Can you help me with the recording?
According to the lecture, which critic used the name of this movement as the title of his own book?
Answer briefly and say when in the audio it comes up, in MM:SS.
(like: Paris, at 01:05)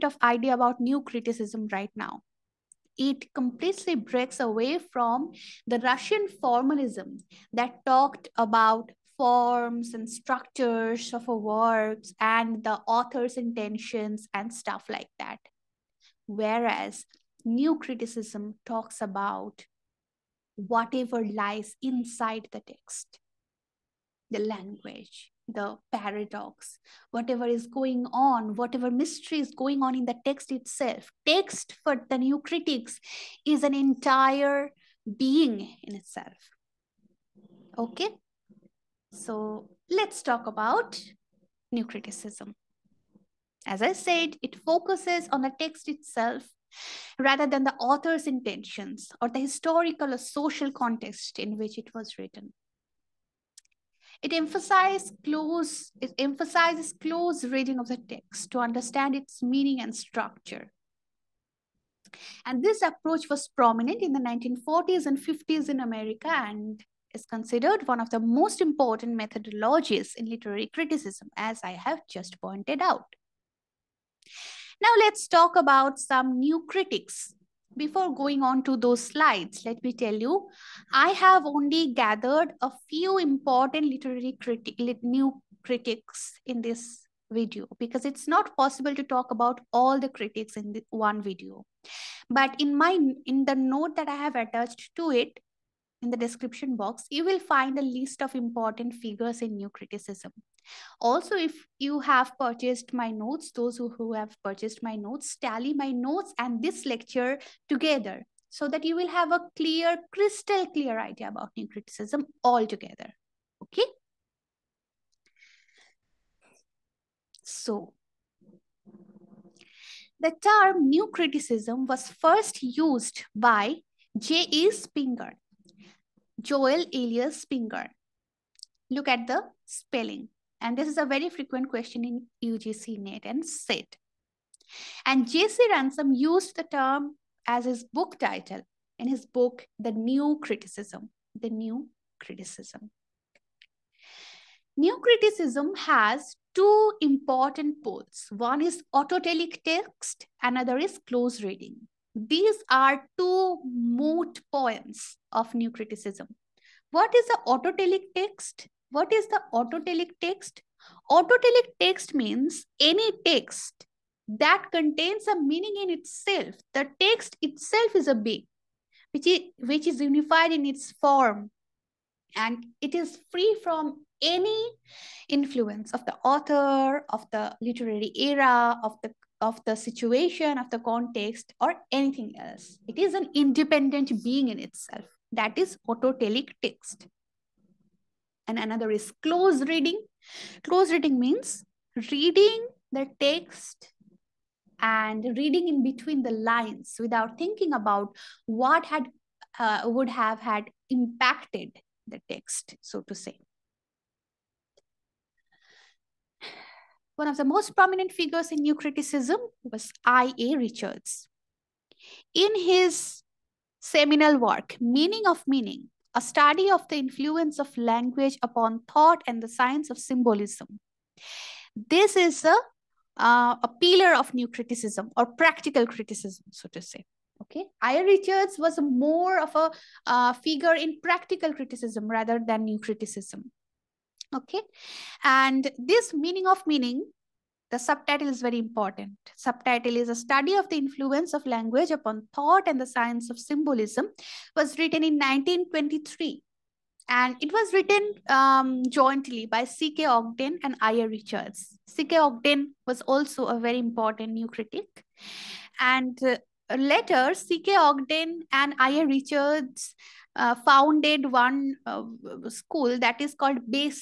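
J.C. Ransom, at 02:15.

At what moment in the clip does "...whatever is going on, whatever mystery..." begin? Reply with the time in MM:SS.
00:27.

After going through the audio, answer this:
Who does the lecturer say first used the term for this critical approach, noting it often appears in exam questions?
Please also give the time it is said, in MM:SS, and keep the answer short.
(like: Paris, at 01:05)
J.E. Spingarn, at 02:04.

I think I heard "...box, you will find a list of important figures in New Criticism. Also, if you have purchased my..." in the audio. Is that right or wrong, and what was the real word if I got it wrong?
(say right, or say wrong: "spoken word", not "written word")
right.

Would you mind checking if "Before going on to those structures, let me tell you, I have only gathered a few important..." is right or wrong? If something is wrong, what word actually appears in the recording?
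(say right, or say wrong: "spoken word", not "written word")
wrong: "slides", not "structures".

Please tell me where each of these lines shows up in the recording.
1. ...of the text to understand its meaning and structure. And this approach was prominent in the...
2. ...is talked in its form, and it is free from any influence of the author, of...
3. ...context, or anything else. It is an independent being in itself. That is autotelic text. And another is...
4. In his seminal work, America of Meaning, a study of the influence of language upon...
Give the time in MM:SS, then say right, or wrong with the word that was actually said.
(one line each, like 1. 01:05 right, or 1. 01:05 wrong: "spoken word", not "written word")
1. 00:57 right
2. 02:49 wrong: "unified", not "talked"
3. 03:00 right
4. 03:32 wrong: "Meaning", not "America".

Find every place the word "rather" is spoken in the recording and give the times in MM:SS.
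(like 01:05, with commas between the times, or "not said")
00:47, 03:52.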